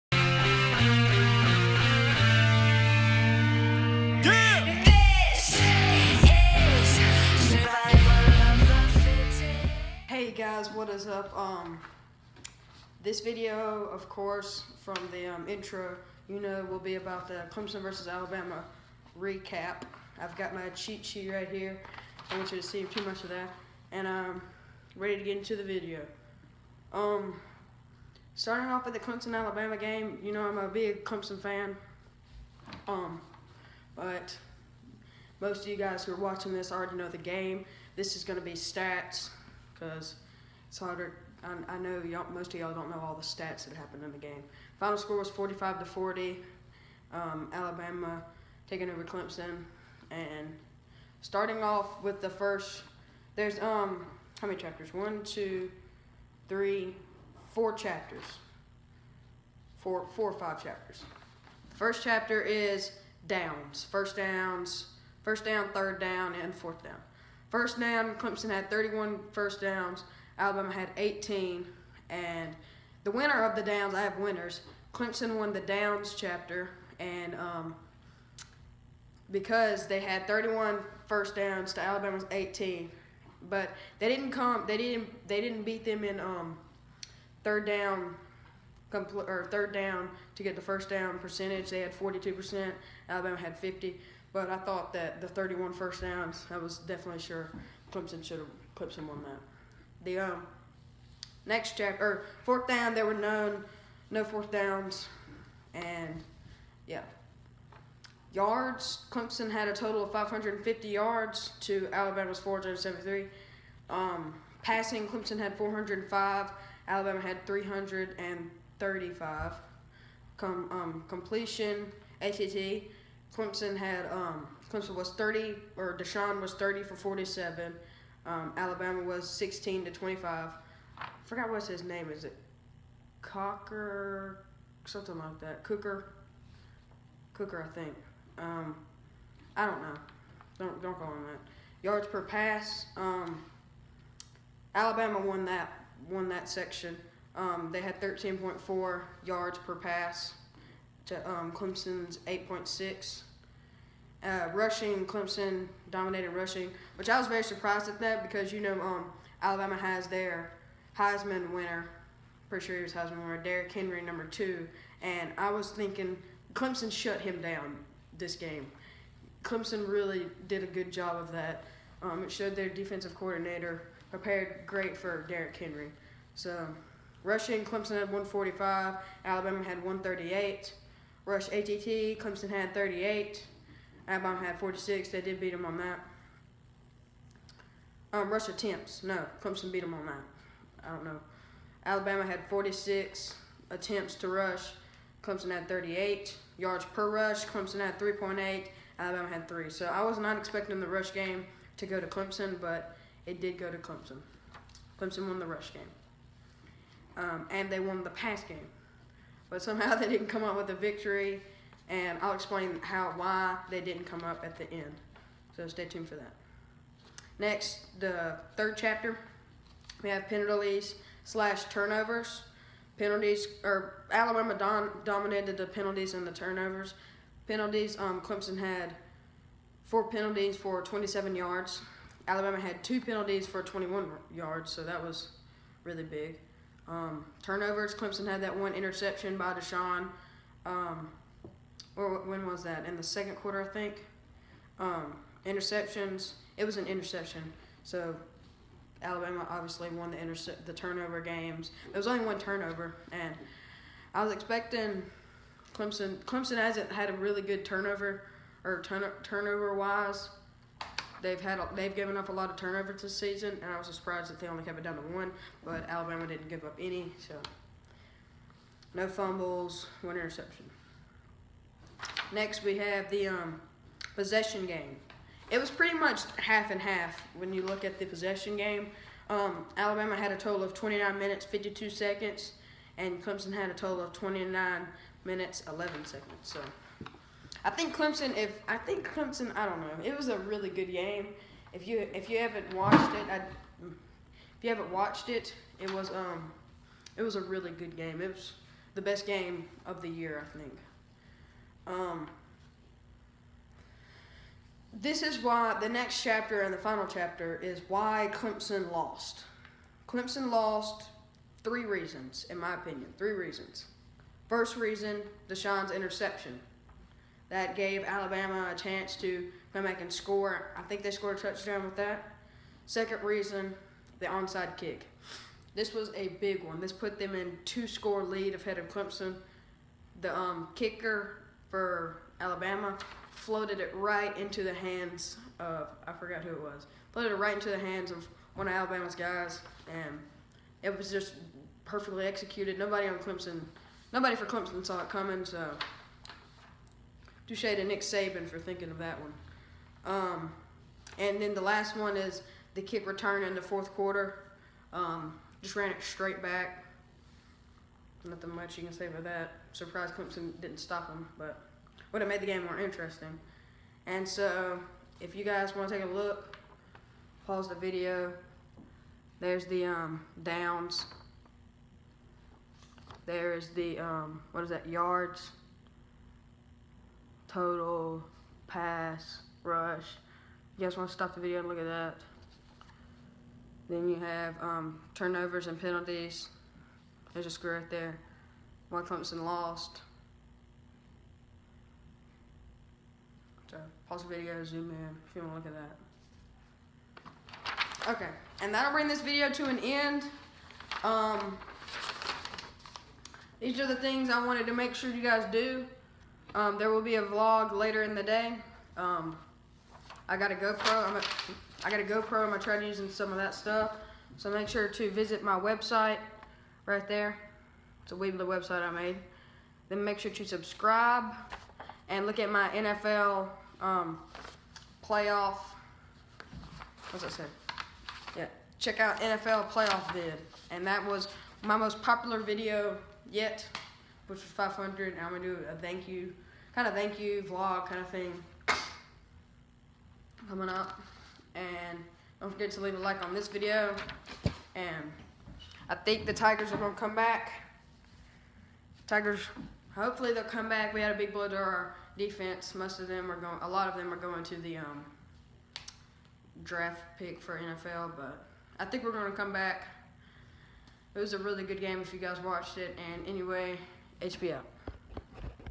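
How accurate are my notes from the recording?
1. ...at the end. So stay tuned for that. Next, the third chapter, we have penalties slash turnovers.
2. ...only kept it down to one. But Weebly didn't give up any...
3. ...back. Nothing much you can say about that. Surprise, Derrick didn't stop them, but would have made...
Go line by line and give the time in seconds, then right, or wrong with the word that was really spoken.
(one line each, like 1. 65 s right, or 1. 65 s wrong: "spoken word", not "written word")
1. 214 s right
2. 264 s wrong: "Alabama", not "Weebly"
3. 356 s wrong: "Clemson", not "Derrick".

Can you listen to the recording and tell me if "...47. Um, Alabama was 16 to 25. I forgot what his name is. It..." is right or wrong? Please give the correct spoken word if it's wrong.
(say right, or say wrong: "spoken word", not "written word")
right.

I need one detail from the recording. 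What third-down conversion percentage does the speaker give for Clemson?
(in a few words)
42%.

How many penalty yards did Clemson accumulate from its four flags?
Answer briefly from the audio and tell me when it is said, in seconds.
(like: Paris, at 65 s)
27, at 229 s.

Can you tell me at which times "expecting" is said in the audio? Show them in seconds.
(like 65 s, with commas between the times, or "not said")
200 s, 254 s.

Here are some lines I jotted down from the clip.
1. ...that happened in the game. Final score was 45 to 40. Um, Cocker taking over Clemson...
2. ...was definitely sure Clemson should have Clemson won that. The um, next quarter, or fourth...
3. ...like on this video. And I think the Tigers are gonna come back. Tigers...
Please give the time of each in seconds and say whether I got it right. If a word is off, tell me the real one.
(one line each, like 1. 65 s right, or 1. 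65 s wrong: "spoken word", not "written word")
1. 43 s wrong: "Alabama", not "Cocker"
2. 96 s wrong: "chapter", not "quarter"
3. 442 s right.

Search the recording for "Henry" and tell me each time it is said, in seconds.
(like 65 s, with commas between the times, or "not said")
163 s, 175 s.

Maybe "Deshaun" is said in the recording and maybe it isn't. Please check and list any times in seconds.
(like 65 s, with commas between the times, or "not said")
125 s, 239 s, 315 s.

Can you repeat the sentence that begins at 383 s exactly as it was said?
Then you have um, turnovers and penalties.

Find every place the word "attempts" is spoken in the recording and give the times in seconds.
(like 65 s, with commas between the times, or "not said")
188 s, 193 s.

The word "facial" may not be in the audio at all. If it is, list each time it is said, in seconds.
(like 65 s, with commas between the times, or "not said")
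not said.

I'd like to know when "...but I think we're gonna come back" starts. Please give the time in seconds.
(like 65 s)
458 s.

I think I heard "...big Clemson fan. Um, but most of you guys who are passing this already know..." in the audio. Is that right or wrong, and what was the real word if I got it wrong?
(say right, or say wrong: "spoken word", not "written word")
wrong: "watching", not "passing".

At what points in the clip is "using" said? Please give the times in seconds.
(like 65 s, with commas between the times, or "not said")
412 s.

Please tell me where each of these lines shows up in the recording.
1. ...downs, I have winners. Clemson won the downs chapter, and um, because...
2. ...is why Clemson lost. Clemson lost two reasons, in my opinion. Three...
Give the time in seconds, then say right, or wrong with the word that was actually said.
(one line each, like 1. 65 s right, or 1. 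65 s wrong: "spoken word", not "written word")
1. 73 s right
2. 307 s wrong: "three", not "two".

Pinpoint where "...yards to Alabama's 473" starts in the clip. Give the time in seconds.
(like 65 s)
110 s.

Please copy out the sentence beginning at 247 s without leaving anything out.
So Alabama obviously won the the turnover games.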